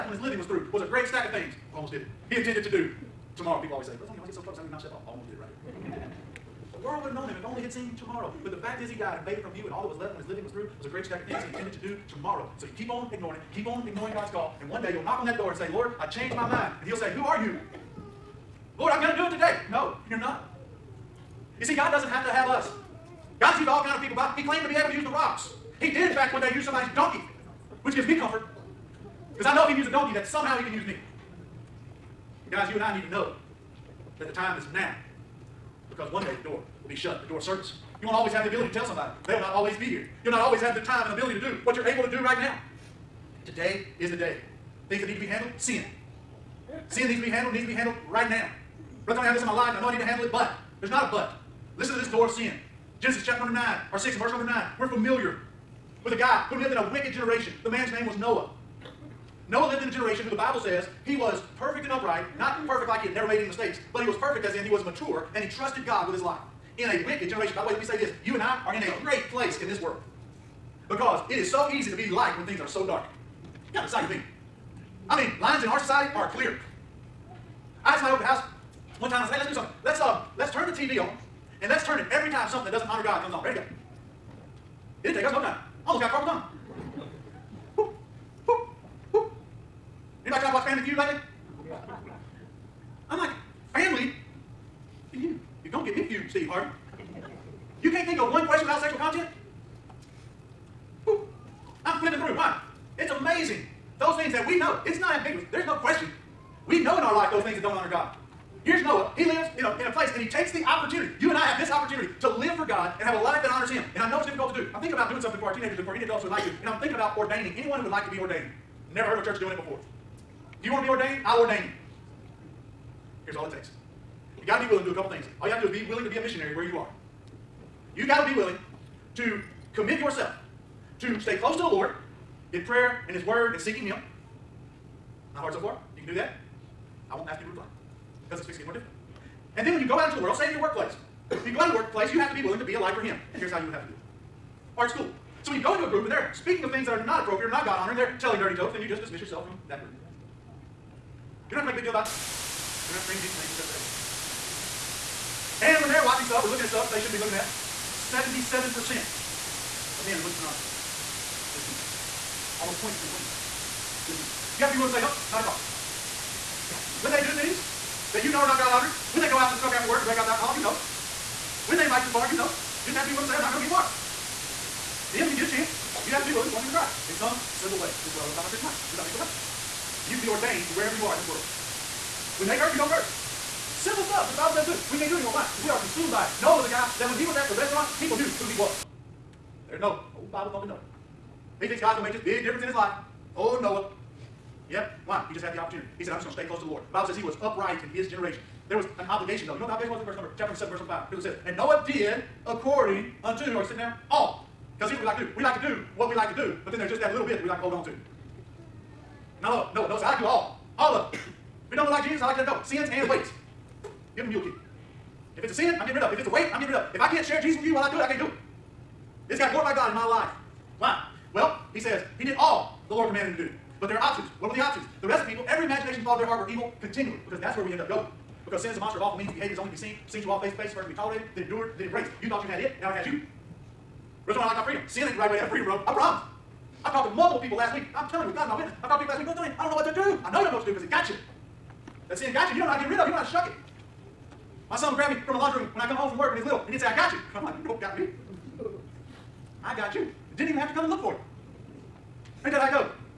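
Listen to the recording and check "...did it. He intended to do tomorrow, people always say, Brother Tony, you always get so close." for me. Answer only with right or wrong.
right.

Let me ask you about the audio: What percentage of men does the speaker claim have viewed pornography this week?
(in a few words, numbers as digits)
77%.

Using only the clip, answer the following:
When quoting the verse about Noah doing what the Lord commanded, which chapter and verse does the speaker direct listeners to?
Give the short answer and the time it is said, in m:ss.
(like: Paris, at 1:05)
Chapter 7, verse 5, at 3:20.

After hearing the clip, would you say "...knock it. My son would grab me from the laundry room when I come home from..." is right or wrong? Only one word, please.
wrong.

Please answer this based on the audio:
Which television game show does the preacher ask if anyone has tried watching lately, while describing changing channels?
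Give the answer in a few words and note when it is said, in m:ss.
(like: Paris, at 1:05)
Family Feud, at 1:30.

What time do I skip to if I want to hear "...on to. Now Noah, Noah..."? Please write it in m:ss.
3:27.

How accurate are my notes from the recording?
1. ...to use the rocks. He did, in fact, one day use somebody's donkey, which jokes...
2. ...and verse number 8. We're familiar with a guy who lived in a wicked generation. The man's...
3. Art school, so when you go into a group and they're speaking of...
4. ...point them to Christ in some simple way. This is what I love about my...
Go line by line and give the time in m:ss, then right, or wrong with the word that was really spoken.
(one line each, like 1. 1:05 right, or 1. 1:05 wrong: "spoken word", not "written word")
1. 0:24 wrong: "gives", not "jokes"
2. 0:54 wrong: "9", not "8"
3. 2:24 right
4. 2:56 right.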